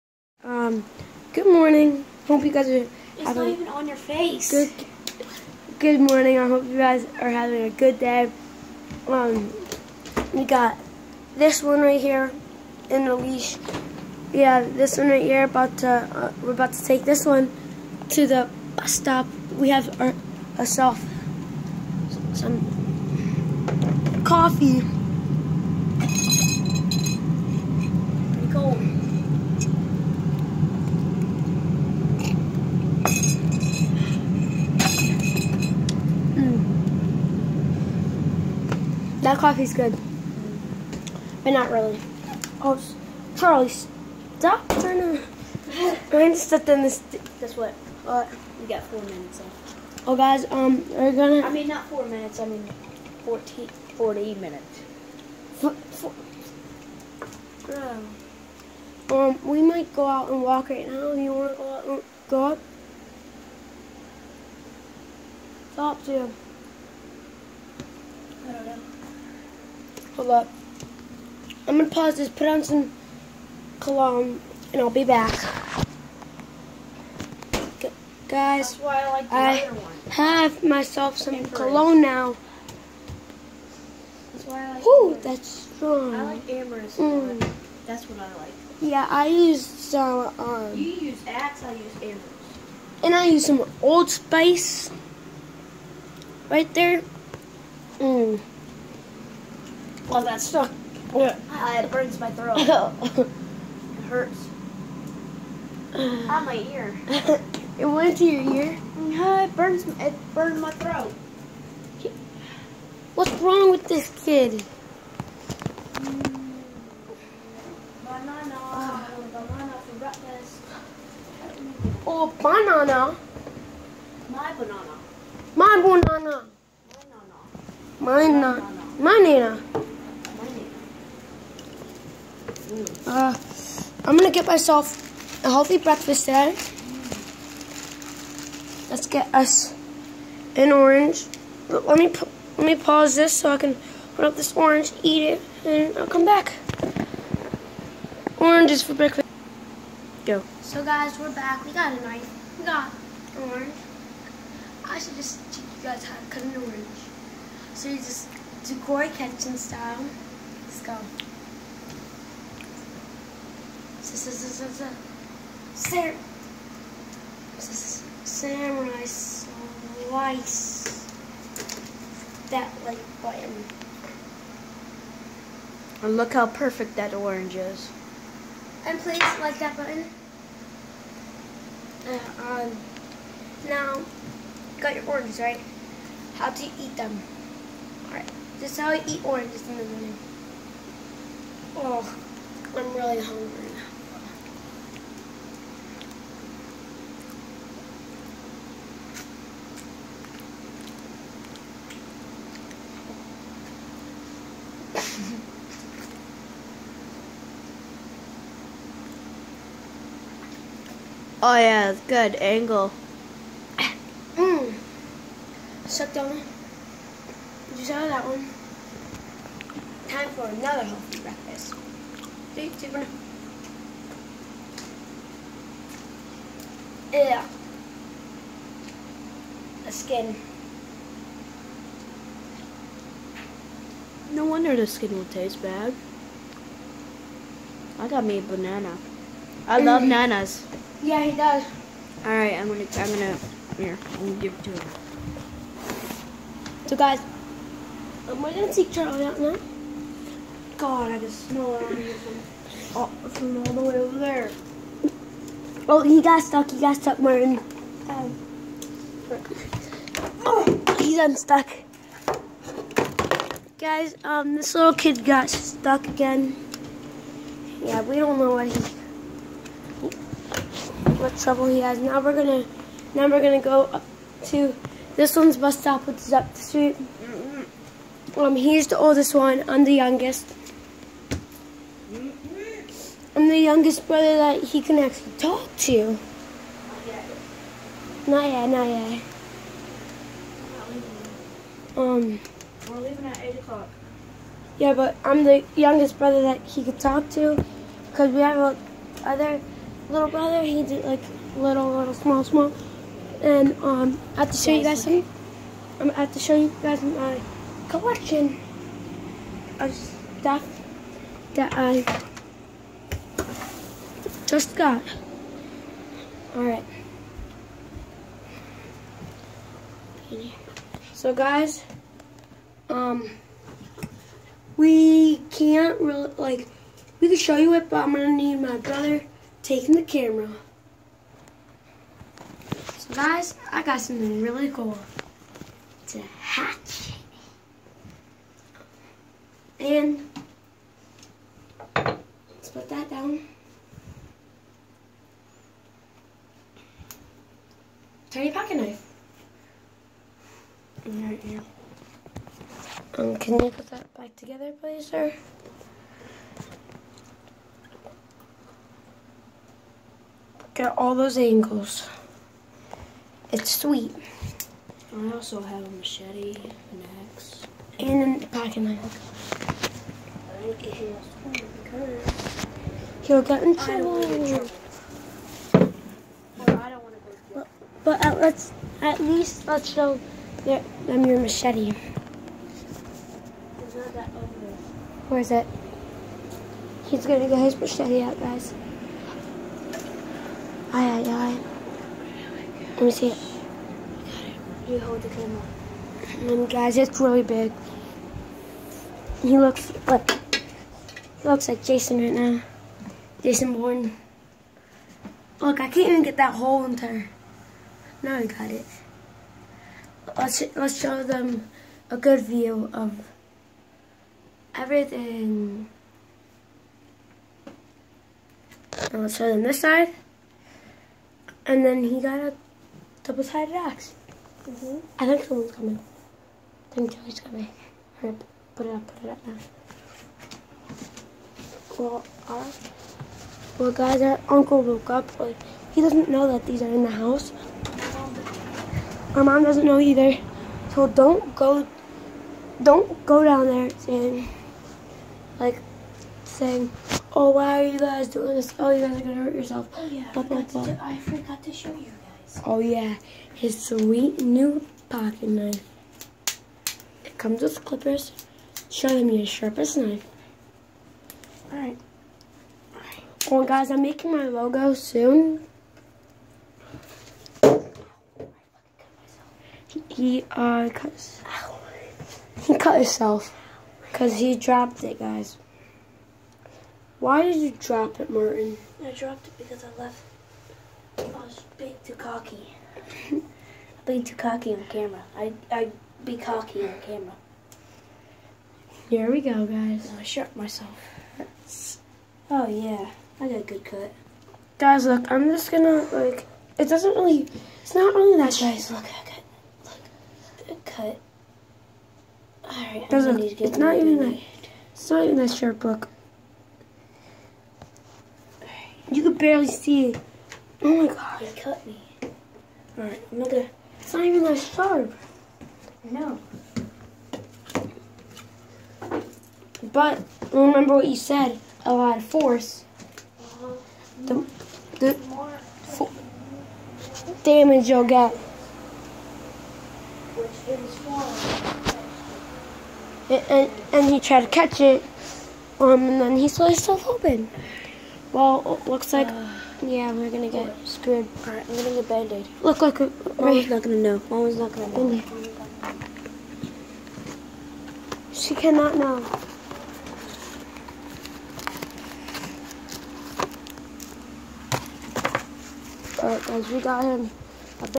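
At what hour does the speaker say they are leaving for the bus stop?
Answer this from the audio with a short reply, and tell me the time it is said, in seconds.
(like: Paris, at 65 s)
8 o'clock, at 293 s.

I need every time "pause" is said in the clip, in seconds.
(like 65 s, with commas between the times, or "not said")
71 s, 142 s.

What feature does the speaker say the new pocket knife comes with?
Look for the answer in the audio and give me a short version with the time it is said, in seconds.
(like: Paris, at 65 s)
Clippers, at 457 s.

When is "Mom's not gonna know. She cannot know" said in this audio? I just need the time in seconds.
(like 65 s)
544 s.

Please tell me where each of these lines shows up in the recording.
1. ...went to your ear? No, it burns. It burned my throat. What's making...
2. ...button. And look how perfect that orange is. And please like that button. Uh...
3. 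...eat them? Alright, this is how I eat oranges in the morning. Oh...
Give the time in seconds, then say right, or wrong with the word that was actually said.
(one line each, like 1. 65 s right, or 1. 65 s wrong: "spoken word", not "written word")
1. 107 s wrong: "wrong", not "making"
2. 173 s right
3. 186 s right.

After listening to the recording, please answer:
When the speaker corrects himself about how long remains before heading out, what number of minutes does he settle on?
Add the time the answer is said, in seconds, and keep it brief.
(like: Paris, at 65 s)
40, at 53 s.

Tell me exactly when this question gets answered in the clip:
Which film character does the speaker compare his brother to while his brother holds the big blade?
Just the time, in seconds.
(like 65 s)
403 s.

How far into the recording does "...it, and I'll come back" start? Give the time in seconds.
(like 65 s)
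145 s.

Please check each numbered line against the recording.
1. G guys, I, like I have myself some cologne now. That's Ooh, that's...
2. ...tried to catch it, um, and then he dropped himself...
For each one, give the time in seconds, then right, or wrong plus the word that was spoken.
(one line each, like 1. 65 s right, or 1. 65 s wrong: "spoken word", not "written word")
1. 77 s right
2. 534 s wrong: "sliced", not "dropped".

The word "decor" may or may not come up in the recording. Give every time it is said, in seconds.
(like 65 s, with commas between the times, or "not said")
158 s.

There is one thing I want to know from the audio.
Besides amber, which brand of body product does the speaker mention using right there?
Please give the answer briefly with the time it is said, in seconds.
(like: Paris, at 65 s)
Old Spice, at 93 s.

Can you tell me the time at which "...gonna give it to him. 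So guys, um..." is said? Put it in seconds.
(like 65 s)
244 s.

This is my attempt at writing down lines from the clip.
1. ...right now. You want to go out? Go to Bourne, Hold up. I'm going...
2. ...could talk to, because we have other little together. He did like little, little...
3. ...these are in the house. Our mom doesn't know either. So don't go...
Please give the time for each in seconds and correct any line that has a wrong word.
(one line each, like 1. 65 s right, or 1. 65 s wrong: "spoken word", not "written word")
1. 60 s wrong: "Stop", not "Bourne"
2. 296 s wrong: "brother", not "together"
3. 436 s right.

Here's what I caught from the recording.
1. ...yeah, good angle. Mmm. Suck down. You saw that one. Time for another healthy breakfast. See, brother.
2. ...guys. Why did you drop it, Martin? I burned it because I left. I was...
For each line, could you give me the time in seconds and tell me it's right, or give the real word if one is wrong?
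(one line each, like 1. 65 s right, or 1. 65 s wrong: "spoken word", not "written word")
1. 211 s wrong: "super", not "brother"
2. 475 s wrong: "dropped", not "burned".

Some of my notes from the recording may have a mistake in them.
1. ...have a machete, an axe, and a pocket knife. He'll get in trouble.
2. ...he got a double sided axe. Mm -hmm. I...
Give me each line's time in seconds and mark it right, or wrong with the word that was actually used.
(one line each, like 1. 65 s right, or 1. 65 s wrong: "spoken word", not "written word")
1. 365 s right
2. 422 s right.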